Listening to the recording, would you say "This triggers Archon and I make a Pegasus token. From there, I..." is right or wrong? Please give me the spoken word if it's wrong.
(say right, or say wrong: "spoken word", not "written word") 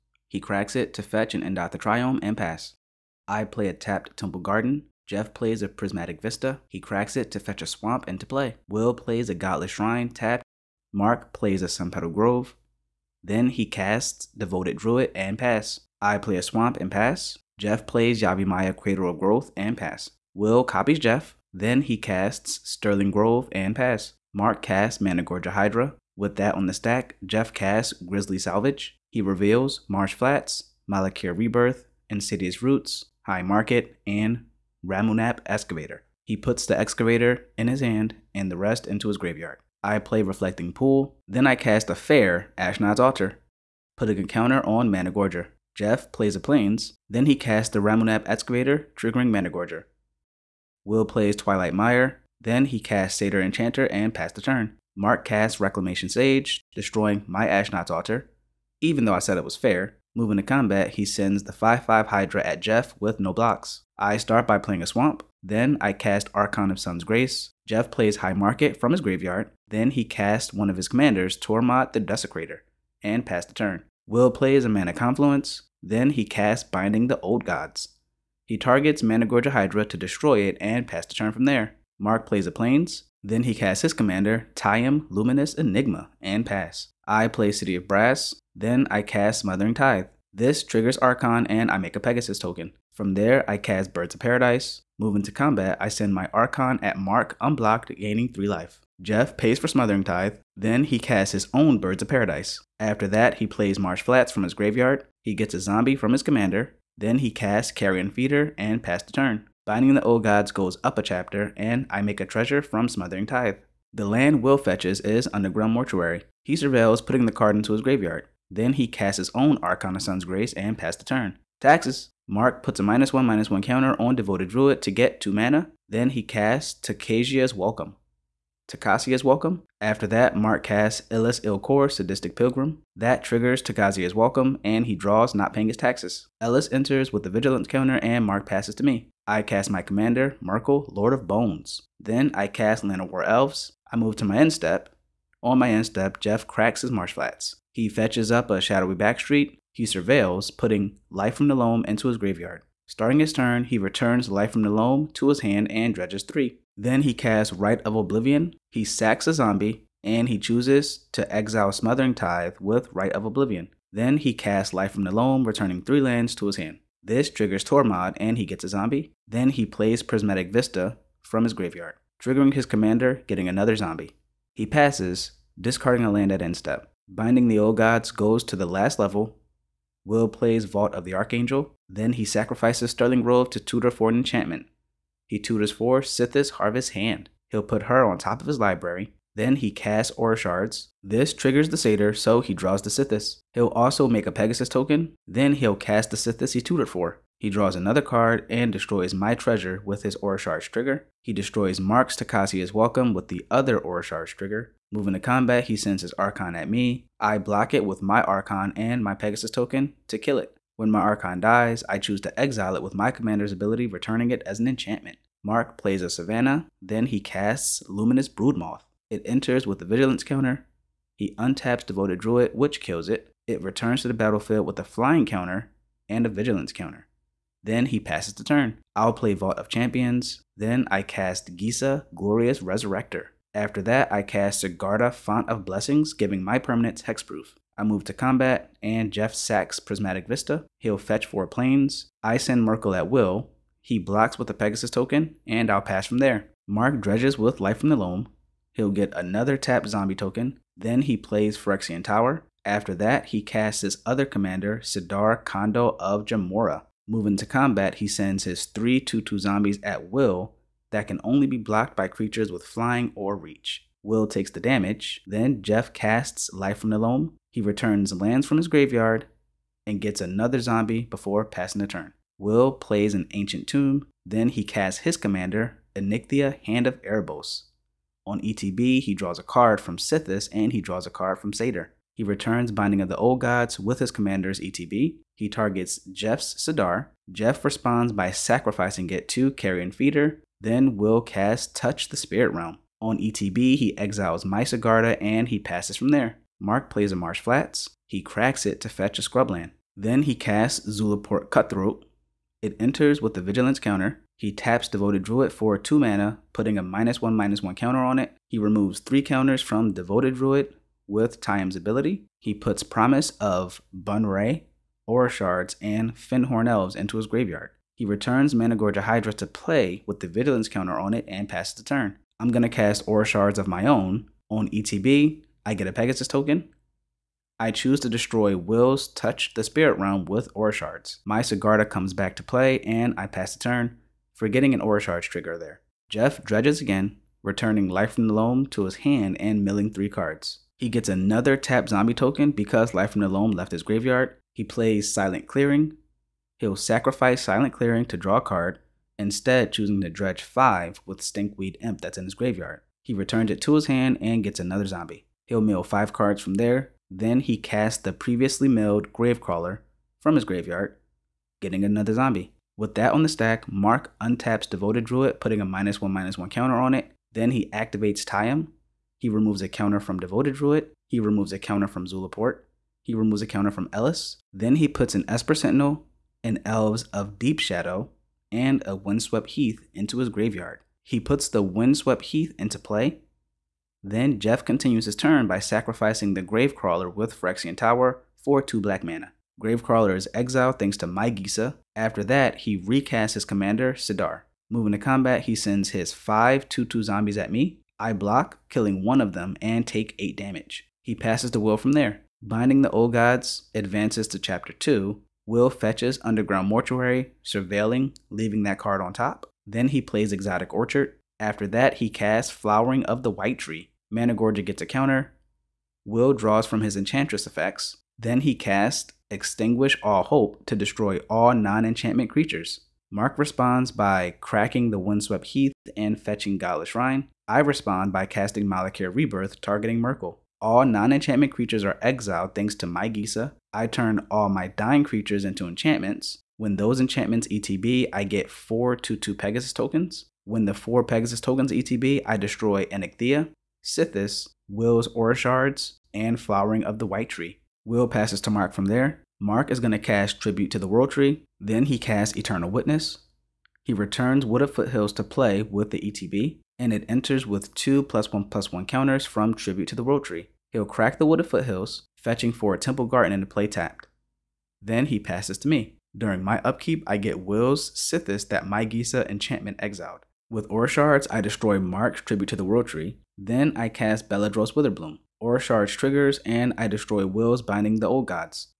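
right.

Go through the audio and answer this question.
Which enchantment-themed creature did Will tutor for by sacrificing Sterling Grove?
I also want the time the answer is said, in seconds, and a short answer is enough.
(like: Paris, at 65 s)
Sythis Harvest Hand, at 186 s.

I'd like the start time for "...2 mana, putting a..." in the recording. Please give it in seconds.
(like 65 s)
305 s.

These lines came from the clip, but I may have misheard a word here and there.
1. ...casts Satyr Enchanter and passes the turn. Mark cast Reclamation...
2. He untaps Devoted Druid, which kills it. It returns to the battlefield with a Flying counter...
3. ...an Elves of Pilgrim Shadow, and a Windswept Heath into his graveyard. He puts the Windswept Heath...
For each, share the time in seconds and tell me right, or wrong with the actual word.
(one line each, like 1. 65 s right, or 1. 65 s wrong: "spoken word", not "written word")
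1. 52 s right
2. 221 s right
3. 376 s wrong: "Deep", not "Pilgrim".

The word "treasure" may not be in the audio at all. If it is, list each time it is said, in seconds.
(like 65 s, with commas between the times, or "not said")
112 s, 199 s.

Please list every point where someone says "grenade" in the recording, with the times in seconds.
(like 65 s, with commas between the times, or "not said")
not said.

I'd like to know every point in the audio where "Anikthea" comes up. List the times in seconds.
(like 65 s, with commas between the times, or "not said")
275 s, 442 s.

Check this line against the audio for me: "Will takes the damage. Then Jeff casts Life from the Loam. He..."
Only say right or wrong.
right.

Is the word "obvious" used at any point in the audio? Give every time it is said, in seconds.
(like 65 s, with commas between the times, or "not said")
not said.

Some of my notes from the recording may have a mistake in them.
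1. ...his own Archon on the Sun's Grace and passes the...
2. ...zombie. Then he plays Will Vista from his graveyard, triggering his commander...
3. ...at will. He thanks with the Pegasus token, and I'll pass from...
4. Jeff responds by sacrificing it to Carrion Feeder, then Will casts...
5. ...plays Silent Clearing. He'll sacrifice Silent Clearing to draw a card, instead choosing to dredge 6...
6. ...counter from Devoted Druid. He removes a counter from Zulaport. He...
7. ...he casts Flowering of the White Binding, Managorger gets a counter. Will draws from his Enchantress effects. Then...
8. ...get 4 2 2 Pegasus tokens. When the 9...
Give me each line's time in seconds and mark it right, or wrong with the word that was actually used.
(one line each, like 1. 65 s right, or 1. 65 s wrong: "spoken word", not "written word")
1. 119 s right
2. 168 s wrong: "Prismatic", not "Will"
3. 242 s wrong: "blocks", not "thanks"
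4. 287 s right
5. 344 s wrong: "5", not "6"
6. 369 s right
7. 411 s wrong: "Tree", not "Binding"
8. 438 s wrong: "4", not "9".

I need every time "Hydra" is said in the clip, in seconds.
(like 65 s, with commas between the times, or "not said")
25 s, 62 s, 79 s, 319 s.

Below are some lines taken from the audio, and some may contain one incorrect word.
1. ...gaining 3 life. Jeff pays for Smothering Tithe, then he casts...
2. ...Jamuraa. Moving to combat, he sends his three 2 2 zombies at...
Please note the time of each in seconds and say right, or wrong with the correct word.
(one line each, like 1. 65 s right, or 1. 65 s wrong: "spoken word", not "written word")
1. 97 s right
2. 256 s right.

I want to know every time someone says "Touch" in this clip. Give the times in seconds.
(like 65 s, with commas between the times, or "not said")
291 s, 329 s.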